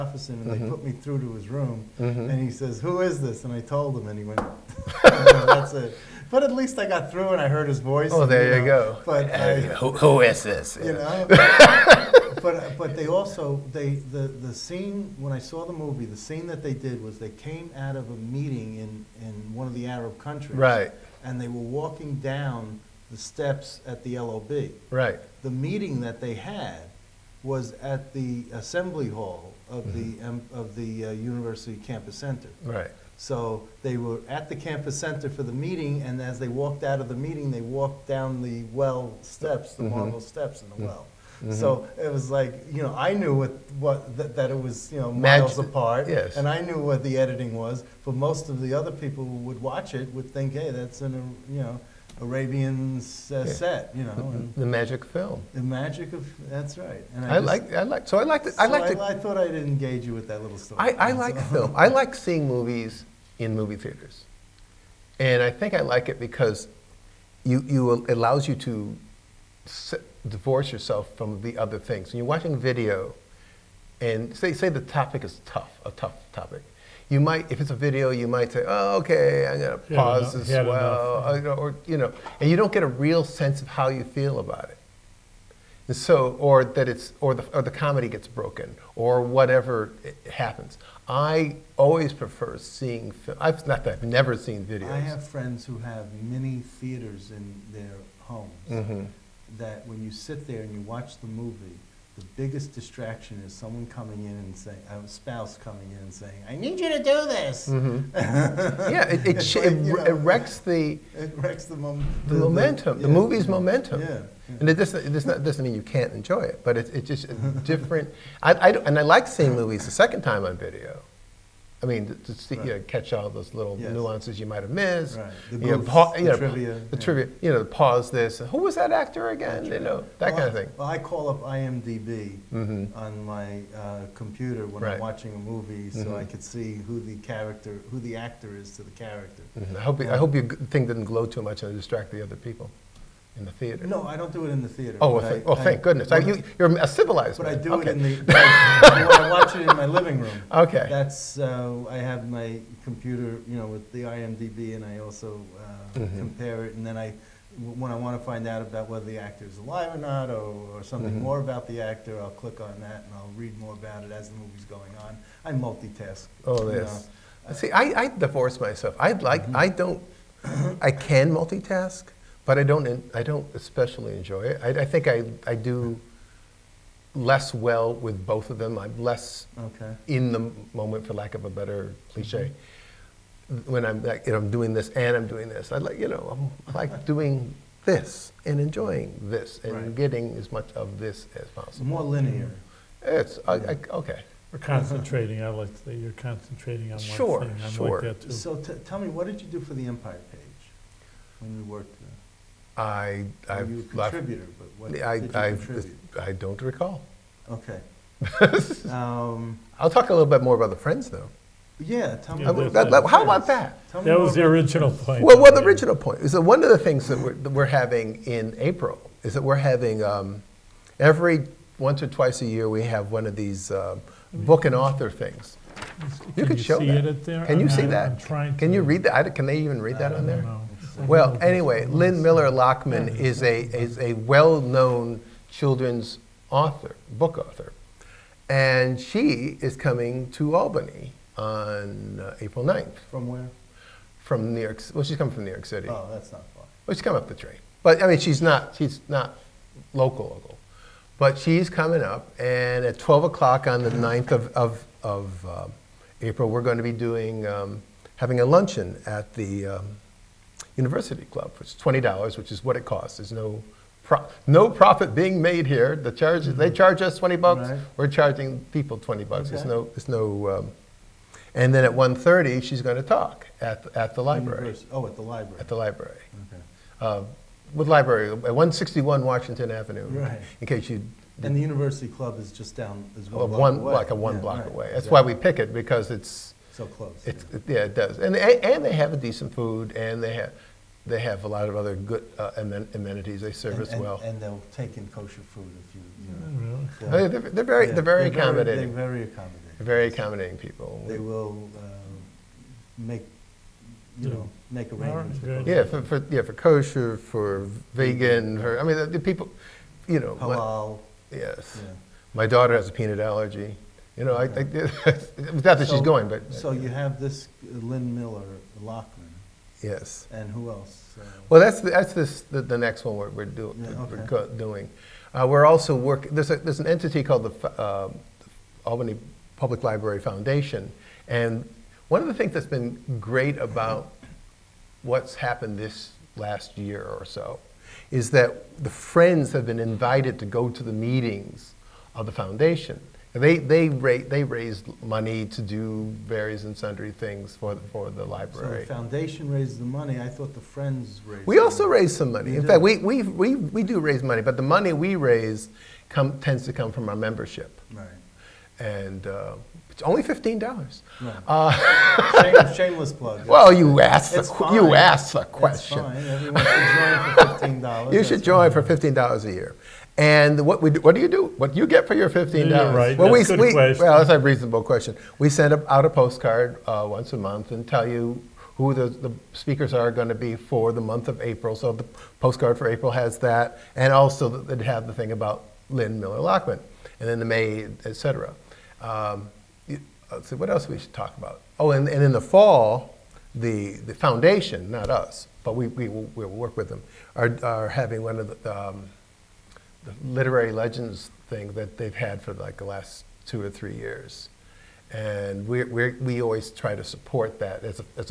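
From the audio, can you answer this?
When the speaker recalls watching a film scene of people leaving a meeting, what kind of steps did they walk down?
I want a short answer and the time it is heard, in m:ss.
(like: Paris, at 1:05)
marble steps, at 0:40.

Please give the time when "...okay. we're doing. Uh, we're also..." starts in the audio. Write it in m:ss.
5:24.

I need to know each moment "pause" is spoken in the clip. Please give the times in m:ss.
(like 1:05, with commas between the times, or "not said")
1:19, 2:07.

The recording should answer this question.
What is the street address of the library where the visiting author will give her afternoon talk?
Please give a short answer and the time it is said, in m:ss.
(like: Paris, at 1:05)
161 Washington Avenue, at 4:38.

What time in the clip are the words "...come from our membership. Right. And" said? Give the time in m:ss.
5:56.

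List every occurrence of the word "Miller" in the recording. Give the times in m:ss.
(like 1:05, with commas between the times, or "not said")
3:52, 5:18, 6:26.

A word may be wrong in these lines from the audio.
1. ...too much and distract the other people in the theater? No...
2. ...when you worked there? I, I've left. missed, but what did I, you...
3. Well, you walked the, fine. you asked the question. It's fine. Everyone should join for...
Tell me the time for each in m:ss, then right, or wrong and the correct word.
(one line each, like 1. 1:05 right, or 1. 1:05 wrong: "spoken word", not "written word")
1. 2:21 right
2. 3:21 wrong: "contributed", not "missed"
3. 6:03 wrong: "asked", not "walked".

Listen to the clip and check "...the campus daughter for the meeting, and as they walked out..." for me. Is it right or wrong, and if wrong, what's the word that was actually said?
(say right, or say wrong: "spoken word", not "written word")
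wrong: "center", not "daughter".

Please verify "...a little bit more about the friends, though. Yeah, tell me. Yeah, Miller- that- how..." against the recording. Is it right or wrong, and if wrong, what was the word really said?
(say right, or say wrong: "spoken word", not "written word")
wrong: "That", not "Miller".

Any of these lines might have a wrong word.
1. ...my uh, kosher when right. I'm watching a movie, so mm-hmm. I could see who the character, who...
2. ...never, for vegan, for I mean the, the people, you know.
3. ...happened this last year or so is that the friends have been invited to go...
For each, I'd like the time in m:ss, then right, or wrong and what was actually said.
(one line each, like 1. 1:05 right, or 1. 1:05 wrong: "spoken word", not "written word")
1. 2:13 wrong: "computer", not "kosher"
2. 5:06 wrong: "kosher", not "never"
3. 5:35 right.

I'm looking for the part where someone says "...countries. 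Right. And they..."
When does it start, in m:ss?
0:20.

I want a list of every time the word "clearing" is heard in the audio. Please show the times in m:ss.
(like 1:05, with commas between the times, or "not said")
not said.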